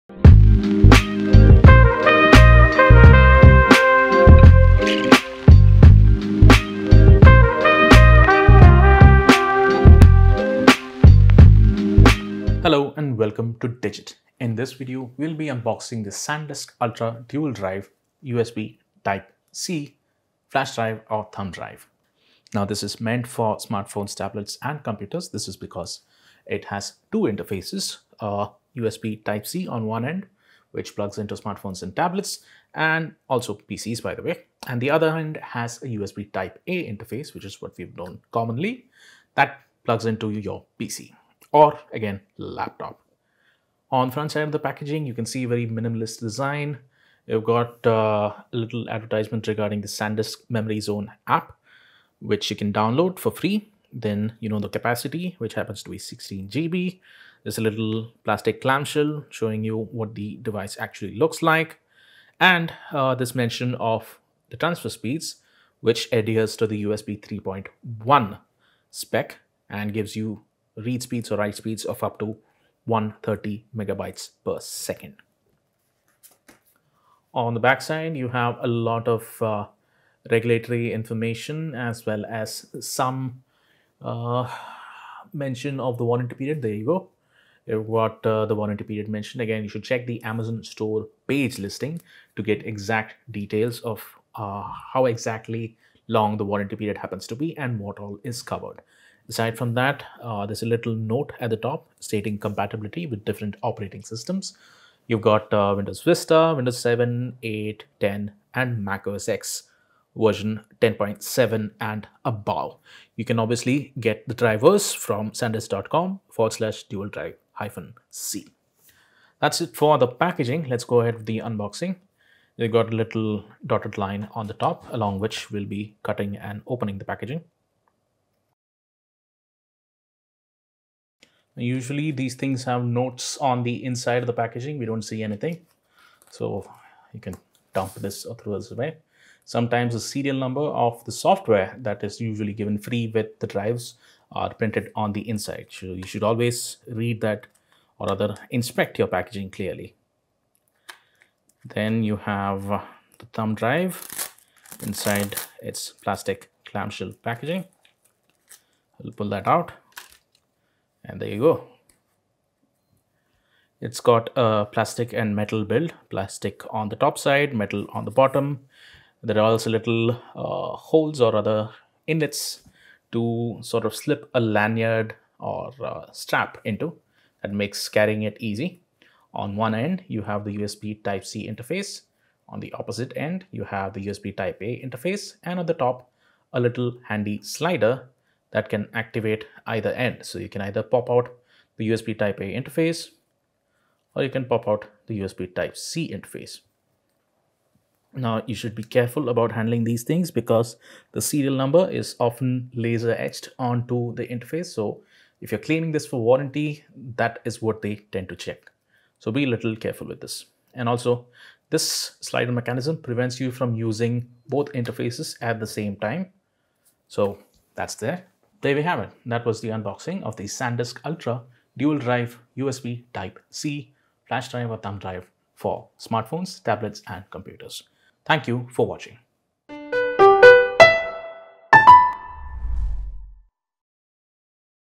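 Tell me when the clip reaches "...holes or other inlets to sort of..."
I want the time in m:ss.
2:50.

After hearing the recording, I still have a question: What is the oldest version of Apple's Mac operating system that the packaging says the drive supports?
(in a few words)
Mac OS X 10.7.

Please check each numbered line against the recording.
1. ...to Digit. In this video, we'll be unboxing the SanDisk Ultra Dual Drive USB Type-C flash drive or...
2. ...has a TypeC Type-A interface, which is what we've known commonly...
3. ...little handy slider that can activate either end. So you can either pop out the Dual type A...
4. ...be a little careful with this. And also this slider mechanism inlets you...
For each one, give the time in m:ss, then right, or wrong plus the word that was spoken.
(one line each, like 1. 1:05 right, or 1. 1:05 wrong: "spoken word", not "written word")
1. 0:13 right
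2. 0:35 wrong: "USB", not "TypeC"
3. 3:06 wrong: "USB", not "Dual"
4. 3:29 wrong: "prevents", not "inlets".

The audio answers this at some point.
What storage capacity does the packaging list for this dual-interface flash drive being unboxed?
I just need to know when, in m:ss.
0:55.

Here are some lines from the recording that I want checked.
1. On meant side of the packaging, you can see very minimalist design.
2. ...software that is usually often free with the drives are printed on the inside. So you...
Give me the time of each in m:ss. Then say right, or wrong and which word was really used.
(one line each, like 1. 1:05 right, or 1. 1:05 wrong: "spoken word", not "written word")
1. 0:43 wrong: "front", not "meant"
2. 2:21 wrong: "given", not "often".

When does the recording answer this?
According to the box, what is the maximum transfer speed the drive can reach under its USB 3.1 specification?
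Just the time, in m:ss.
1:12.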